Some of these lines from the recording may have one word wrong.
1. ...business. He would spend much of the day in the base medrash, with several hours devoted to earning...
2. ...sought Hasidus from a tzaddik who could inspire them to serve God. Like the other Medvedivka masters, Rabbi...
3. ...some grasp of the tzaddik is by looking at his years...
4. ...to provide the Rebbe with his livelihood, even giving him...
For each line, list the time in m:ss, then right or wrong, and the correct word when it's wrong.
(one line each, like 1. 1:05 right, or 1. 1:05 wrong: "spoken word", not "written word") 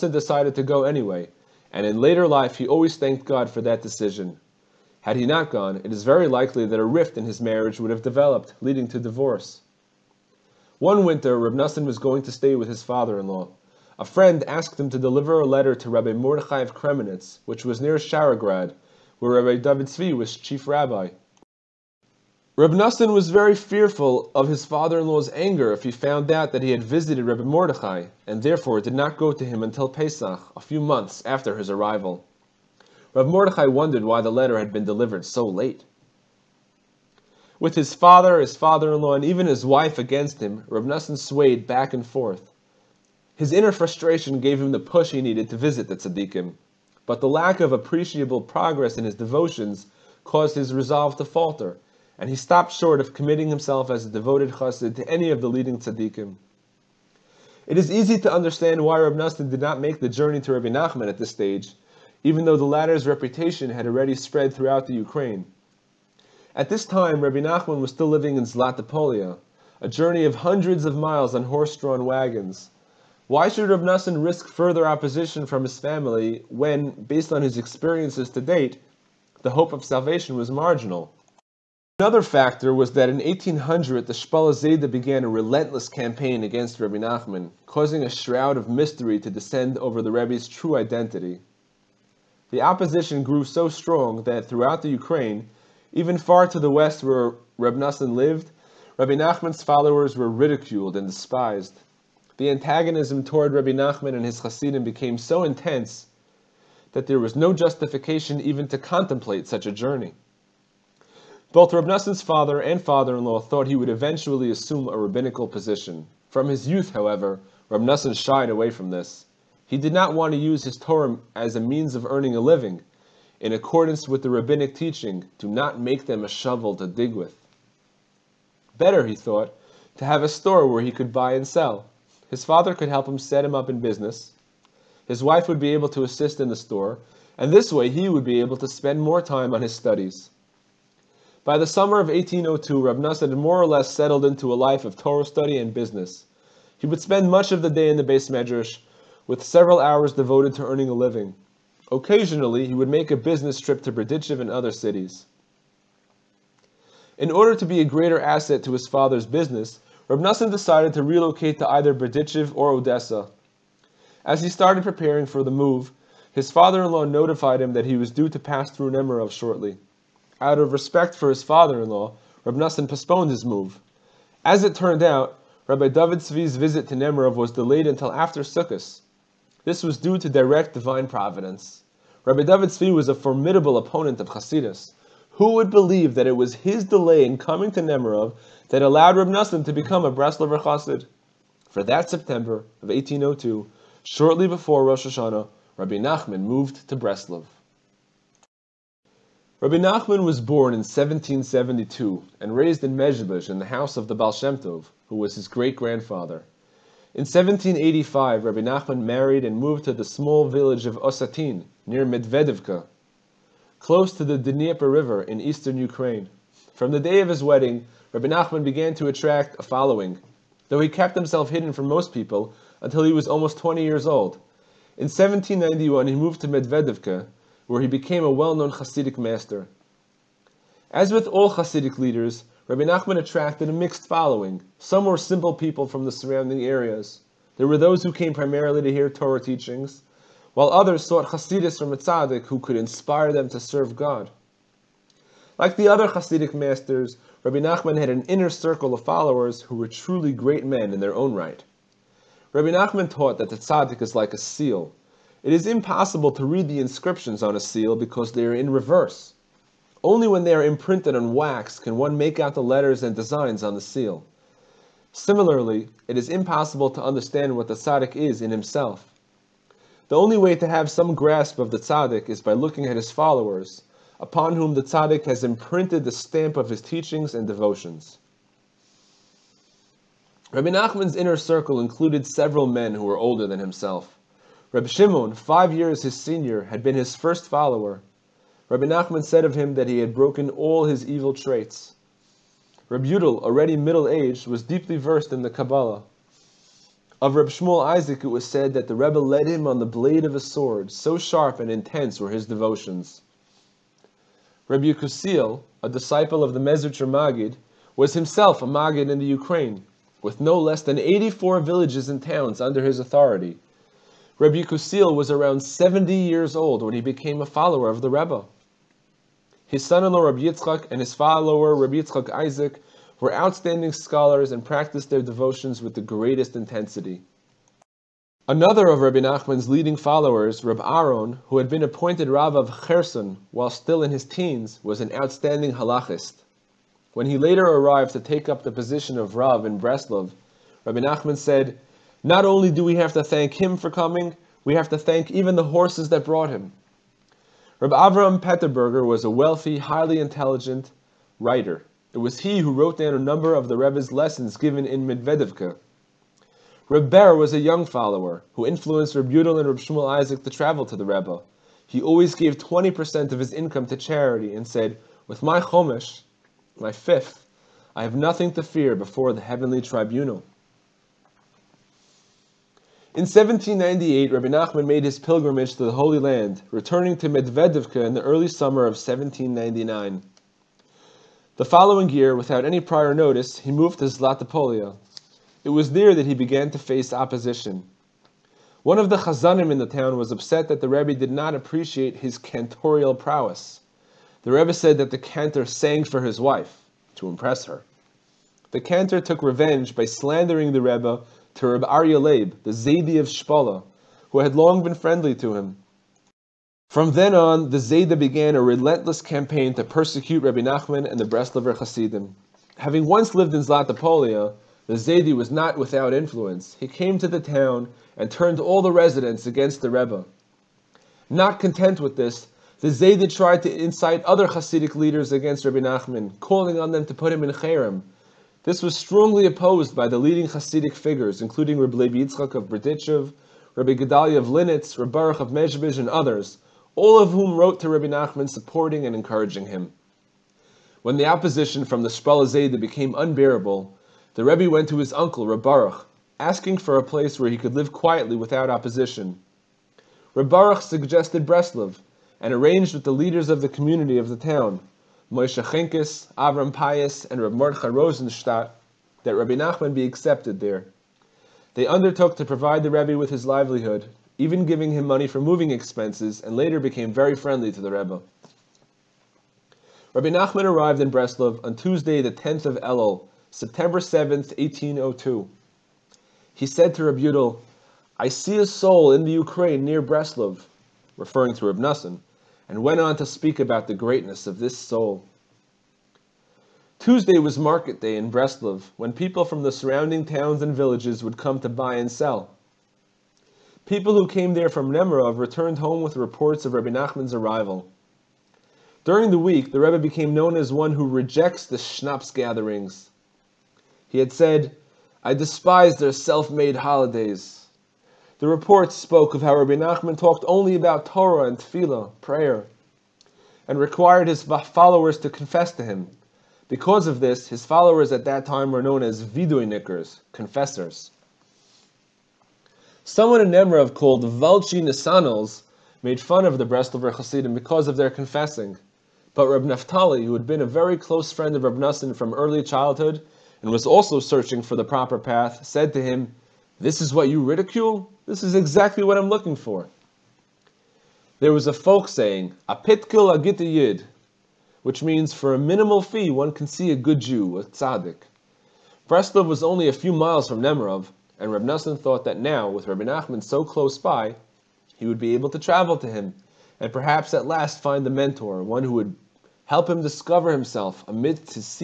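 1. 2:25 right
2. 4:01 wrong: "Hasidic", not "Medvedivka"
3. 4:30 wrong: "followers", not "years"
4. 7:42 right.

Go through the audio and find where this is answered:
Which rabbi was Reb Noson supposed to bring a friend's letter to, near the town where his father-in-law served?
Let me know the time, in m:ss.
0:15.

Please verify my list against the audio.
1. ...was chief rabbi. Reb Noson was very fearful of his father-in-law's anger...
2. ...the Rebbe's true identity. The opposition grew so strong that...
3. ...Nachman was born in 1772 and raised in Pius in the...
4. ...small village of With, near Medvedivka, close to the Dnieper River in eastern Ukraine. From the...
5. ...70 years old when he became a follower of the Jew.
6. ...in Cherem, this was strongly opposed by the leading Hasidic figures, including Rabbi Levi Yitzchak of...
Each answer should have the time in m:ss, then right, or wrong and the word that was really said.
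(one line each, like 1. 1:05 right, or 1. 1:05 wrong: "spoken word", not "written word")
1. 0:20 right
2. 1:29 right
3. 3:19 wrong: "Mezhebezh", not "Pius"
4. 3:30 wrong: "Osatin", not "With"
5. 5:15 wrong: "Rebbe", not "Jew"
6. 7:07 right.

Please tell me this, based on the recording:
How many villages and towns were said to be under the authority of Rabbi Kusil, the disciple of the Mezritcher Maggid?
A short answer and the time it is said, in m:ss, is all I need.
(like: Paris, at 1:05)
84, at 5:10.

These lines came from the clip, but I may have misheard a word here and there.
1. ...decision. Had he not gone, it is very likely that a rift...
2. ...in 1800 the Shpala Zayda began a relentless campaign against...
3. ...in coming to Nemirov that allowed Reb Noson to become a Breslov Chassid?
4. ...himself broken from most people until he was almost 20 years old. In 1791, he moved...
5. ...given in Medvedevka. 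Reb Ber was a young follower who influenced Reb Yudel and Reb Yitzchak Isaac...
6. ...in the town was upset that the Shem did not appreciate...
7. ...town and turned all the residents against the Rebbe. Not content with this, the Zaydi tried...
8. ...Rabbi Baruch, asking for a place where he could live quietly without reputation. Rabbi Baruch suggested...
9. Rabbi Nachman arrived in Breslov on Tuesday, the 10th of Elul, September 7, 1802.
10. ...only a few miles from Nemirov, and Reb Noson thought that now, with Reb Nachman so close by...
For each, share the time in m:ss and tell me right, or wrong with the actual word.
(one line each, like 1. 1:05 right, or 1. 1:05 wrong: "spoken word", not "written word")
1. 0:03 right
2. 1:23 right
3. 3:07 right
4. 3:41 wrong: "hidden", not "broken"
5. 5:54 wrong: "Shmuel", not "Yitzchak"
6. 6:29 wrong: "Rebbe", not "Shem"
7. 6:57 right
8. 7:25 wrong: "opposition", not "reputation"
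9. 7:50 right
10. 9:09 right.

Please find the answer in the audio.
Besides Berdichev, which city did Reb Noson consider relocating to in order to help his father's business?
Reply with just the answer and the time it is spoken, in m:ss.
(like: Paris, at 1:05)
Odessa, at 2:42.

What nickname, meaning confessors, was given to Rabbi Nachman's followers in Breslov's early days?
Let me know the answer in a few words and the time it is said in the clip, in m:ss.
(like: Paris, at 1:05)
viduinikers, at 8:39.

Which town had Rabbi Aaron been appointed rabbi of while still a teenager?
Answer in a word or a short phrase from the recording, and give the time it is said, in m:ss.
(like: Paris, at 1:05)
Kherson, at 5:32.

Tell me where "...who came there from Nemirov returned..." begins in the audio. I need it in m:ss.
8:14.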